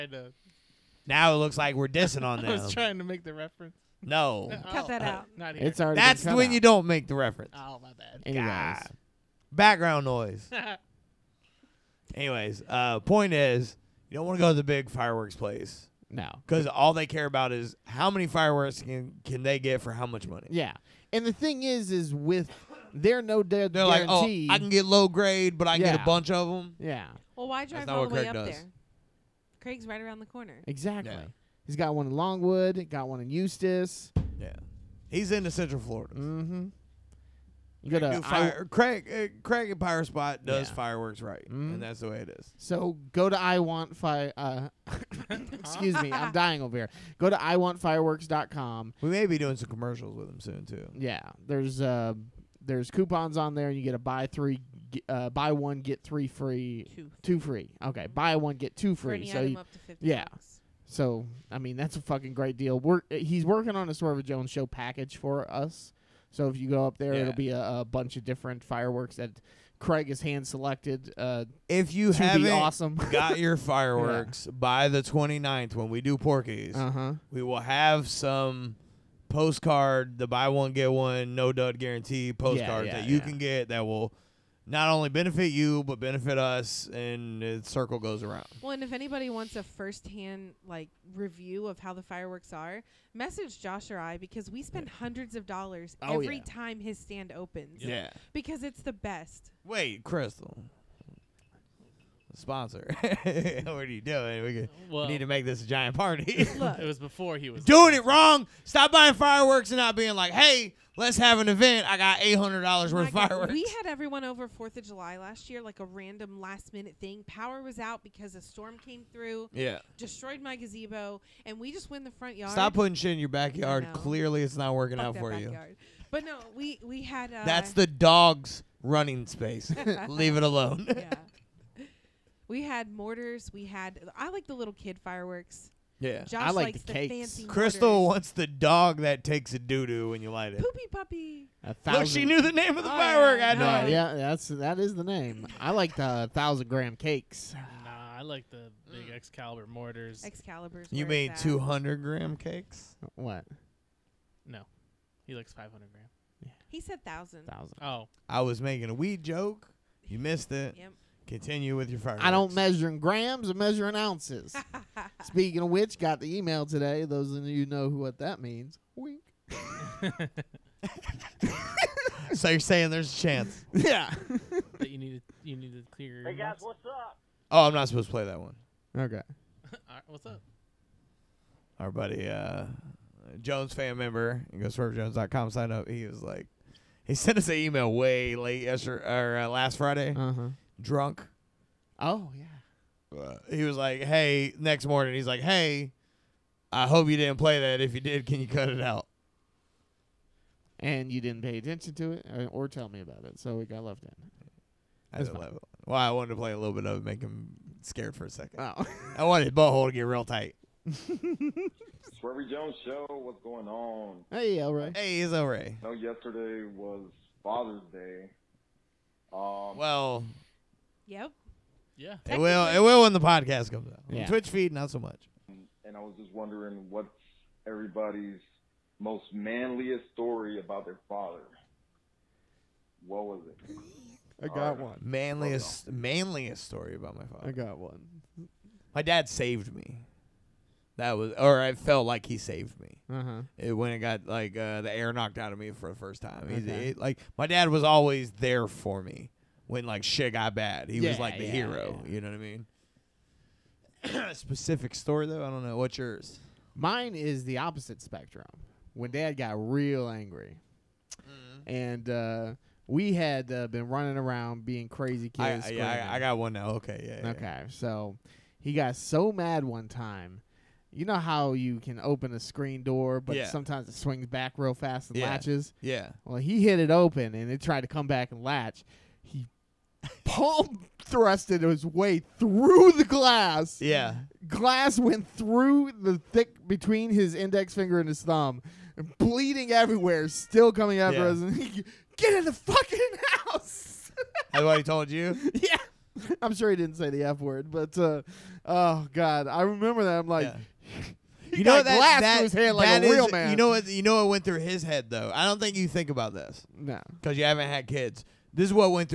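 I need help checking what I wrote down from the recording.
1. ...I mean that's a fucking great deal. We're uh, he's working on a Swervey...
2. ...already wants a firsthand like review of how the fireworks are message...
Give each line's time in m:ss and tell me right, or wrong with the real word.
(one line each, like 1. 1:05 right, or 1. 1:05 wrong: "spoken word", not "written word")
1. 1:01 right
2. 1:28 wrong: "anybody", not "already".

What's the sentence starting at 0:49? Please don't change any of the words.
We may be doing some commercials with them soon too.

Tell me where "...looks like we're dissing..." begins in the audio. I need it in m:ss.
0:01.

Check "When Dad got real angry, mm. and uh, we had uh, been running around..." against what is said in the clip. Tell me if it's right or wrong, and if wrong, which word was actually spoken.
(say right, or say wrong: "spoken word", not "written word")
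right.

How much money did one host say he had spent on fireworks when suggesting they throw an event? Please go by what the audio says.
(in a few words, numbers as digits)
$800.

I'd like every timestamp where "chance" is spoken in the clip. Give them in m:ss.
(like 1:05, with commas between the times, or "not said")
2:53.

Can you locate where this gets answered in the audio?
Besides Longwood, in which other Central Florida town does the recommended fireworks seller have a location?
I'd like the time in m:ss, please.
0:33.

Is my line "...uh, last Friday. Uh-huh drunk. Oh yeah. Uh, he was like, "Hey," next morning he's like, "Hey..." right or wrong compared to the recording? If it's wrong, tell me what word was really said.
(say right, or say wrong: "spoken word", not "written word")
right.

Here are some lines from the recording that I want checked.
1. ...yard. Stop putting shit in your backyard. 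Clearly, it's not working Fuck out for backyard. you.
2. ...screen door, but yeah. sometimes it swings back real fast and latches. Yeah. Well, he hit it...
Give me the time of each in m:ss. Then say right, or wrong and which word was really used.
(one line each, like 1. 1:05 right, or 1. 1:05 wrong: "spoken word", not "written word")
1. 2:02 right
2. 4:32 right.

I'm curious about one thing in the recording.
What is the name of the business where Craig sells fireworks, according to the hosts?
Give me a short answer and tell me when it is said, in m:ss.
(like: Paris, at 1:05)
Pyro Spot, at 0:39.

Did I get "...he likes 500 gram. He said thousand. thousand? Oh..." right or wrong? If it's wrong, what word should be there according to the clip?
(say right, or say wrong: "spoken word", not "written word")
right.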